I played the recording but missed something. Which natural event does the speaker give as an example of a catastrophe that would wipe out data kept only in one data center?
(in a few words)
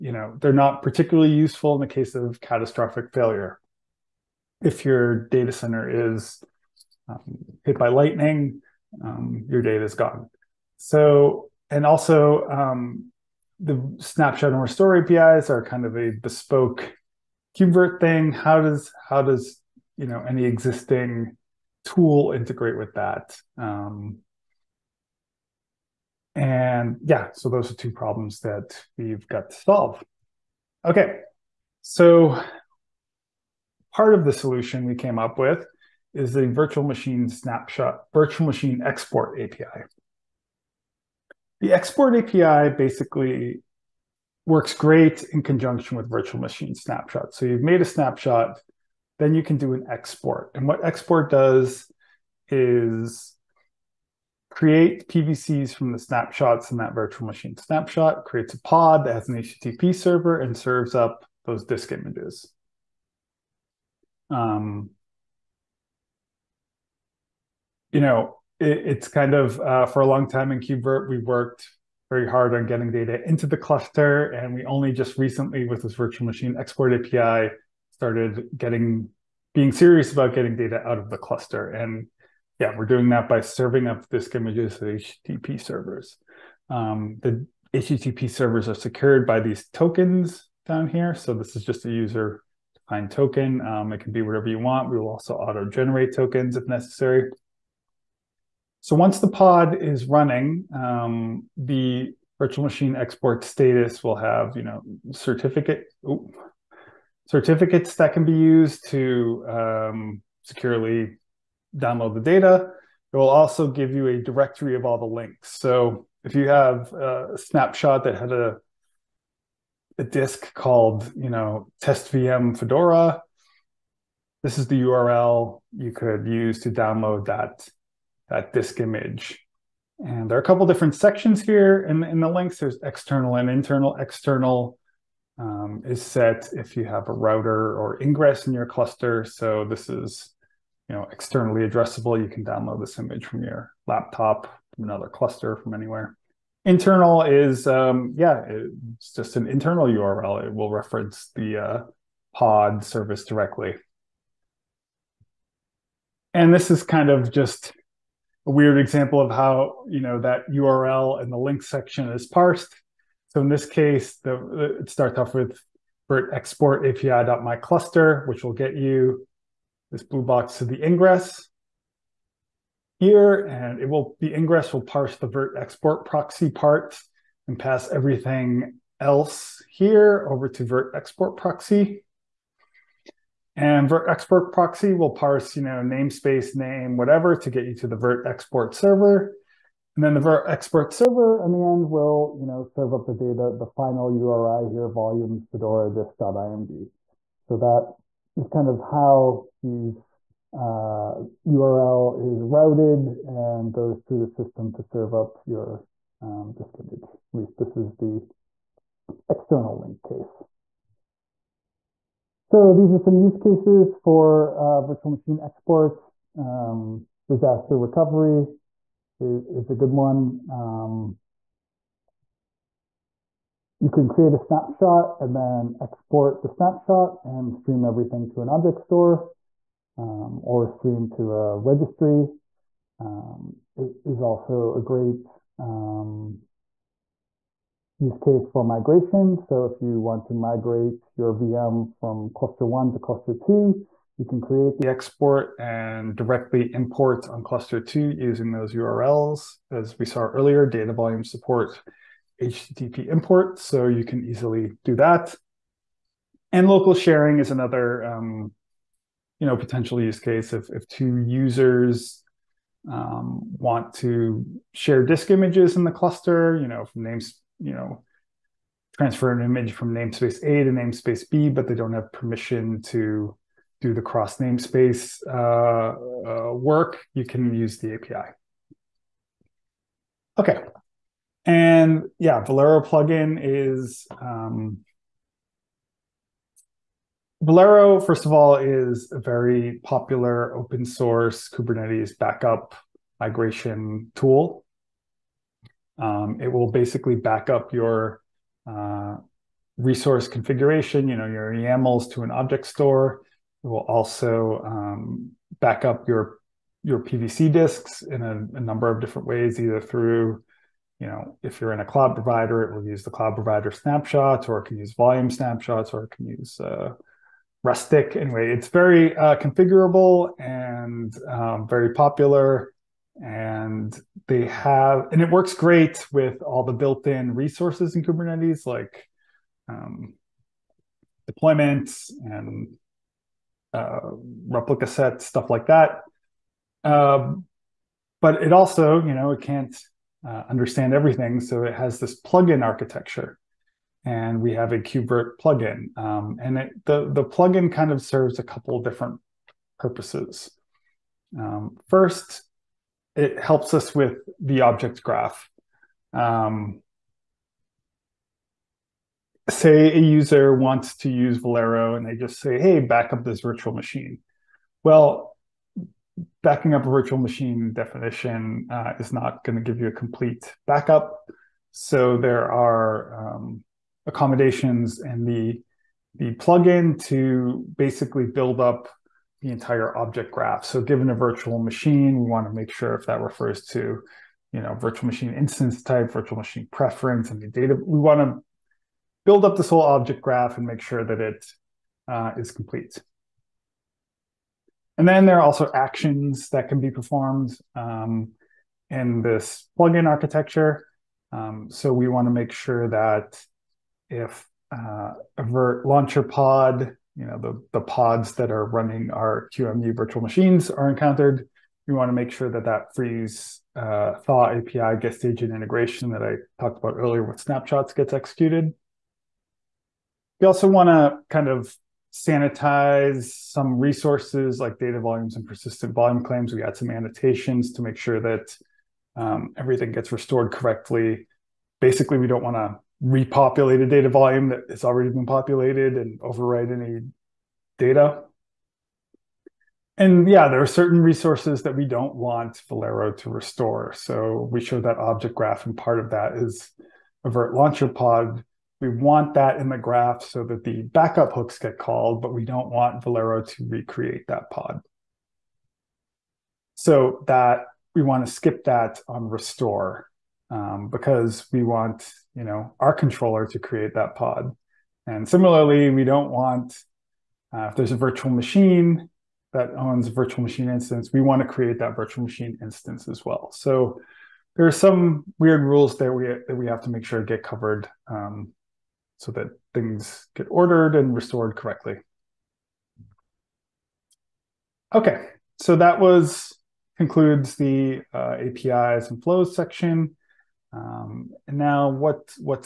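lightning.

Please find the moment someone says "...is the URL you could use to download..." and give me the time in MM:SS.
02:04.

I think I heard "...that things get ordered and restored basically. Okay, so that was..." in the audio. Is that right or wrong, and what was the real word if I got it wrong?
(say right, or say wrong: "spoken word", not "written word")
wrong: "correctly", not "basically".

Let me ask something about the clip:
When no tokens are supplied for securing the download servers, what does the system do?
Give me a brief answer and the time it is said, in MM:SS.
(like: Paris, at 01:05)
auto generate tokens, at 01:35.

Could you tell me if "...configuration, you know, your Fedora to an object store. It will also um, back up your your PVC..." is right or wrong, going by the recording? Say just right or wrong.
wrong.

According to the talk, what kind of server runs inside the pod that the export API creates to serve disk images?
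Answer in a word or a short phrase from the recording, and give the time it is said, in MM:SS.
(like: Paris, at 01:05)
HTTP server, at 00:59.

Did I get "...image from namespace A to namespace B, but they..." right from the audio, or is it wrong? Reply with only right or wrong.
right.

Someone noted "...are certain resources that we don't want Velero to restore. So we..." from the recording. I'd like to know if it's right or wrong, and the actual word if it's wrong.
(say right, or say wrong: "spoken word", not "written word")
right.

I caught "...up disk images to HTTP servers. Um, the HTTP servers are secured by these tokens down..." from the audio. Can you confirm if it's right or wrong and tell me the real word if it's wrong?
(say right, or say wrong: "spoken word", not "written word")
right.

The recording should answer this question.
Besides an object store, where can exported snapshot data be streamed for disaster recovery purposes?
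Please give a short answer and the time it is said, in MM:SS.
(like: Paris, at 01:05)
a registry, at 03:51.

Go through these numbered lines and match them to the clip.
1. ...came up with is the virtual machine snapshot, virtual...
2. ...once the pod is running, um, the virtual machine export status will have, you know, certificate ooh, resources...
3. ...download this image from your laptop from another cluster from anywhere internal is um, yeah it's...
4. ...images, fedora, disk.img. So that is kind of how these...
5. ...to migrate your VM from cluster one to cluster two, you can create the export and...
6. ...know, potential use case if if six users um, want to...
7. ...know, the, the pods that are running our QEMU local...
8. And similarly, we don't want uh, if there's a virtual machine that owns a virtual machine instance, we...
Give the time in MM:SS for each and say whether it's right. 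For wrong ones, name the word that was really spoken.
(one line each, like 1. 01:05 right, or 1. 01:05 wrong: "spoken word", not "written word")
1. 00:34 right
2. 01:38 wrong: "certificates", not "resources"
3. 02:22 right
4. 03:14 wrong: "volumes", not "images"
5. 04:00 right
6. 04:19 wrong: "two", not "six"
7. 06:47 wrong: "virtual", not "local"
8. 07:45 right.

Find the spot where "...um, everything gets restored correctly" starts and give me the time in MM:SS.
07:09.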